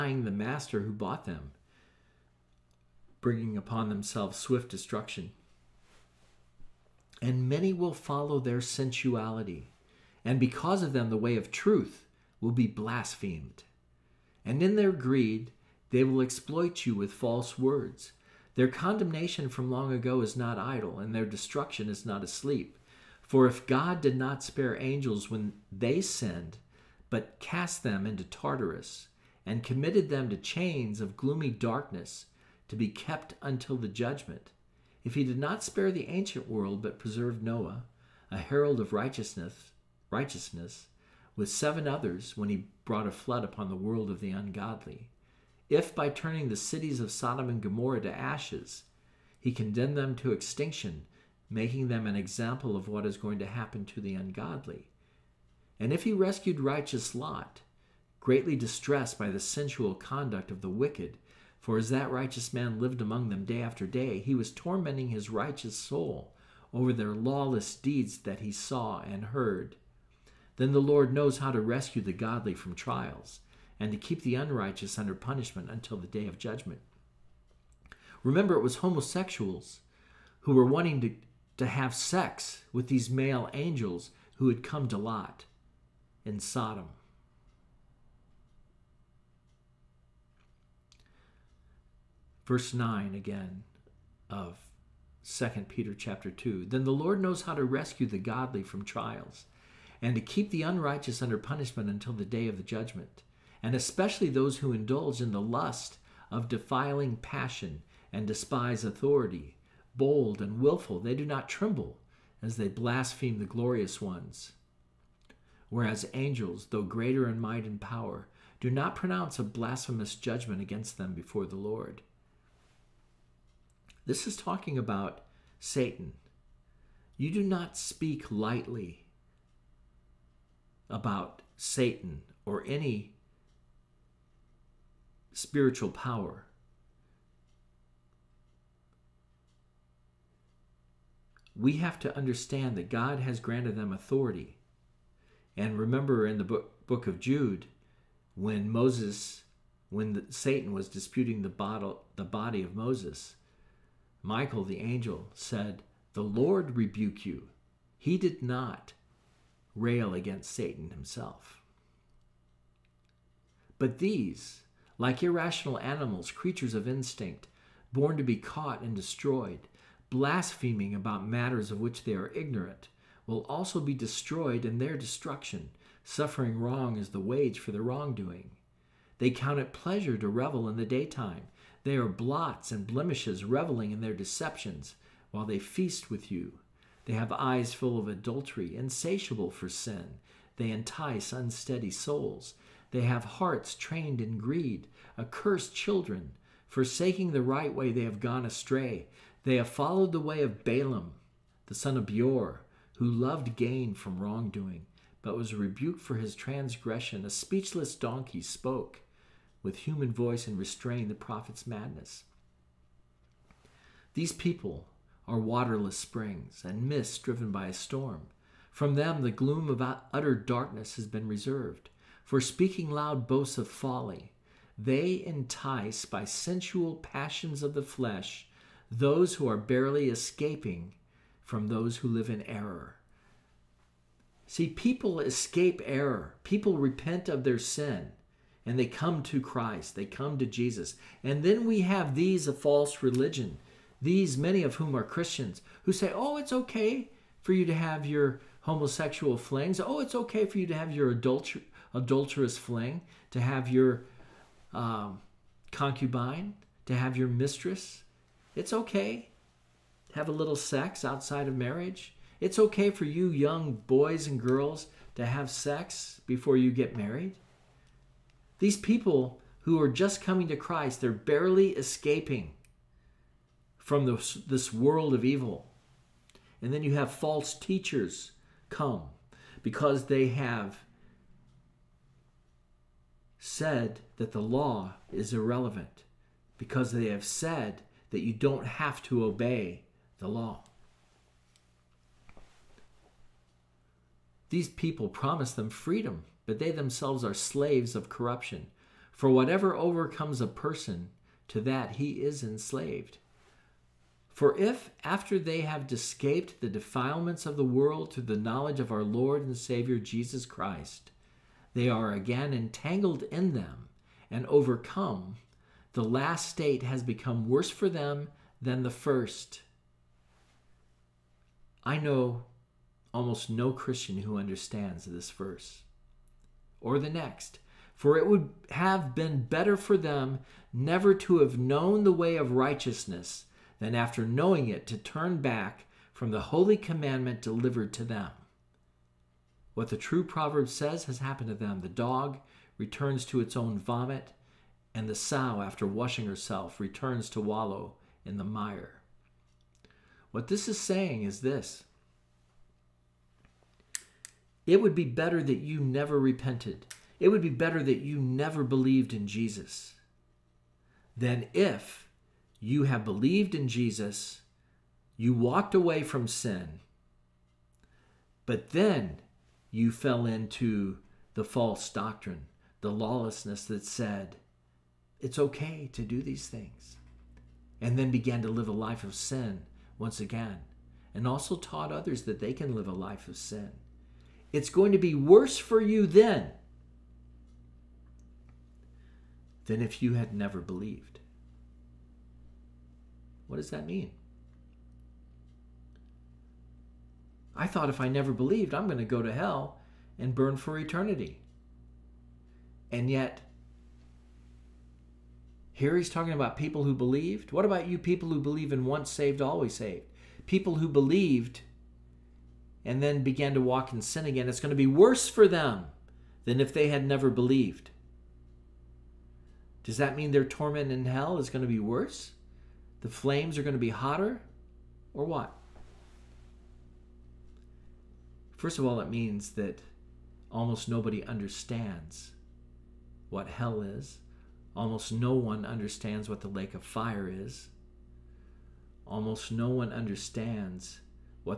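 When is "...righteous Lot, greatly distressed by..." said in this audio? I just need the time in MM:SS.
00:56.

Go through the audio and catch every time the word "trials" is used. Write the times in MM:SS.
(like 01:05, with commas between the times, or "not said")
01:12, 01:38.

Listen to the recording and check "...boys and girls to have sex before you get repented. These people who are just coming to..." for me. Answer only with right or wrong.
wrong.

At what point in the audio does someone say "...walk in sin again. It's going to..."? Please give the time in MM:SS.
06:53.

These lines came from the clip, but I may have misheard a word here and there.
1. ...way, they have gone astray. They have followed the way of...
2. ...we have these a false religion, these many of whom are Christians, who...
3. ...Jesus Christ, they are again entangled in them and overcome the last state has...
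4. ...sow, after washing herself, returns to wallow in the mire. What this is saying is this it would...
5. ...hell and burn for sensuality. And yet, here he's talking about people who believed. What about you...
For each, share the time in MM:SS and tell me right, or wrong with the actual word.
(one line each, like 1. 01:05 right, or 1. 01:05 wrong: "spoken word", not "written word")
1. 03:17 right
2. 04:01 right
3. 05:09 right
4. 05:45 right
5. 06:39 wrong: "eternity", not "sensuality".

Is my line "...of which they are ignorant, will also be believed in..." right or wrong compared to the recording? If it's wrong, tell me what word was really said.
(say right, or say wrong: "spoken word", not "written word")
wrong: "destroyed", not "believed".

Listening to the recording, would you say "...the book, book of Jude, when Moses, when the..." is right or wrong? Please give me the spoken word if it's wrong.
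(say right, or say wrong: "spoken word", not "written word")
right.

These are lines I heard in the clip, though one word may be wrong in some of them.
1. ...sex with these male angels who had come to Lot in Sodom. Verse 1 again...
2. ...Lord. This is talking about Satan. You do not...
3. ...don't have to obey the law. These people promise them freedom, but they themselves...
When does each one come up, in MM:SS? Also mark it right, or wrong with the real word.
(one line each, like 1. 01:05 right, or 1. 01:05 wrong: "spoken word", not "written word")
1. 01:21 wrong: "9", not "1"
2. 02:01 right
3. 04:48 right.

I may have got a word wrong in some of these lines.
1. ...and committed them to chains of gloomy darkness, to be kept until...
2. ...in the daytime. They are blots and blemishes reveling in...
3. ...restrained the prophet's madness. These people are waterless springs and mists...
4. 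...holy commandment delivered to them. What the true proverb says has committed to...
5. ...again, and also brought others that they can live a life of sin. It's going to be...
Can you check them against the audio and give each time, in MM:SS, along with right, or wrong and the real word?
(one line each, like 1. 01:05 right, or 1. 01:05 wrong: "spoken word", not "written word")
1. 00:29 right
2. 03:00 right
3. 03:30 right
4. 05:36 wrong: "happened", not "committed"
5. 06:20 wrong: "taught", not "brought".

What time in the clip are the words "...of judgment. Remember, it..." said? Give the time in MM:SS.
01:16.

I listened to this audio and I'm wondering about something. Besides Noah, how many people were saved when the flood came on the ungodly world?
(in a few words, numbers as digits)
7.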